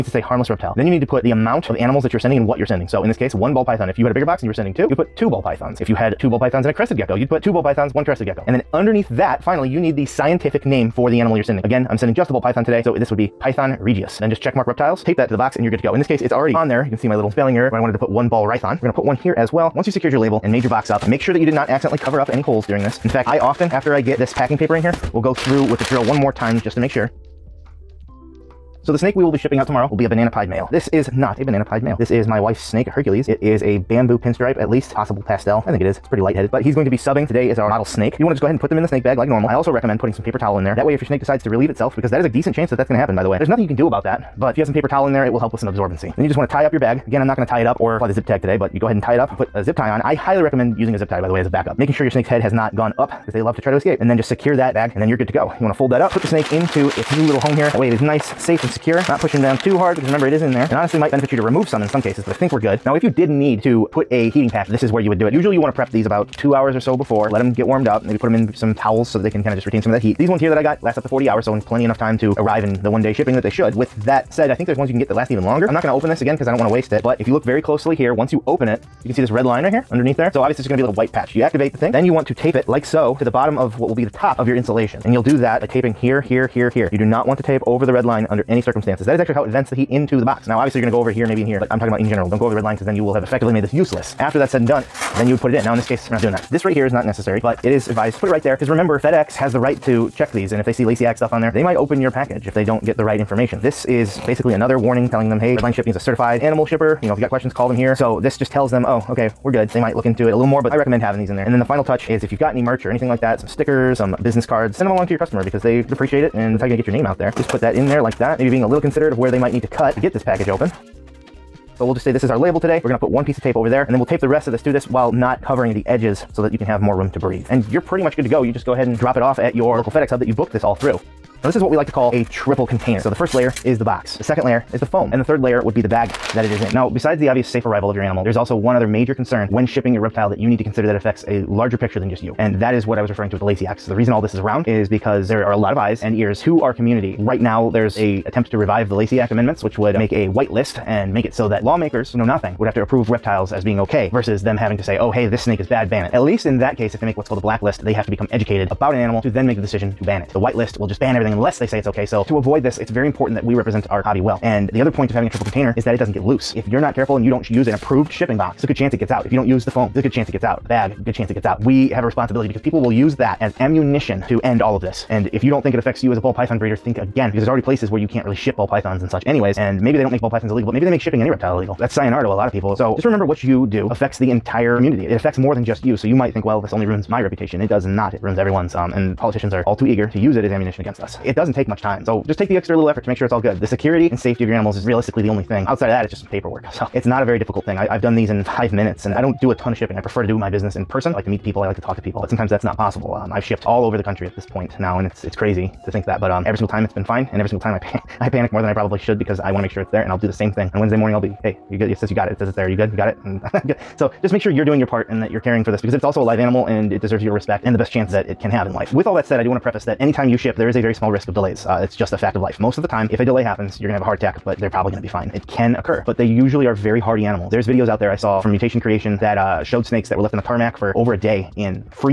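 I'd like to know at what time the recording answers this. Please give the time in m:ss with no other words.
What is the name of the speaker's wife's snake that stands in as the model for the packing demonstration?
0:32.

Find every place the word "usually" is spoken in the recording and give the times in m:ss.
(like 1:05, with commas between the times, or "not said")
1:05, 3:46.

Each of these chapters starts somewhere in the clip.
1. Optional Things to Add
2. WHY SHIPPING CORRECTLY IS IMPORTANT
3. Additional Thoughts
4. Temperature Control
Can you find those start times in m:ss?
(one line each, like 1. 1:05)
1. 1:36
2. 2:10
3. 3:38
4. 1:02.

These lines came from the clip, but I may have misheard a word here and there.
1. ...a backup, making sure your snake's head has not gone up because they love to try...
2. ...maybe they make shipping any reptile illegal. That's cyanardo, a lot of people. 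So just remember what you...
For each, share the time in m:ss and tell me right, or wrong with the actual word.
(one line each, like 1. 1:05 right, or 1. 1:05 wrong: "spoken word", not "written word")
1. 0:51 right
2. 3:00 right.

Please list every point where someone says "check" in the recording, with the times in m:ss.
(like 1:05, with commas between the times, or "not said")
0:14, 1:40.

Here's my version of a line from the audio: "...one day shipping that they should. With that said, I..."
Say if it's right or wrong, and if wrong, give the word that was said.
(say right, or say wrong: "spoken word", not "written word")
right.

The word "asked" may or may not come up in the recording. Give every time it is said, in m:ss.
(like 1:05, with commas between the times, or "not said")
not said.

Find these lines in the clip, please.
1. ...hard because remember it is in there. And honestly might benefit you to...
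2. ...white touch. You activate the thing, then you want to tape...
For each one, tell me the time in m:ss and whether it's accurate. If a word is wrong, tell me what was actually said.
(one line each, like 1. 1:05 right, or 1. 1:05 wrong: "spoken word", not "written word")
1. 0:59 right
2. 1:20 wrong: "patch", not "touch".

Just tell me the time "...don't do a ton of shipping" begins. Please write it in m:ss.
3:19.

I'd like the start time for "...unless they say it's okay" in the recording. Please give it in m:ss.
2:41.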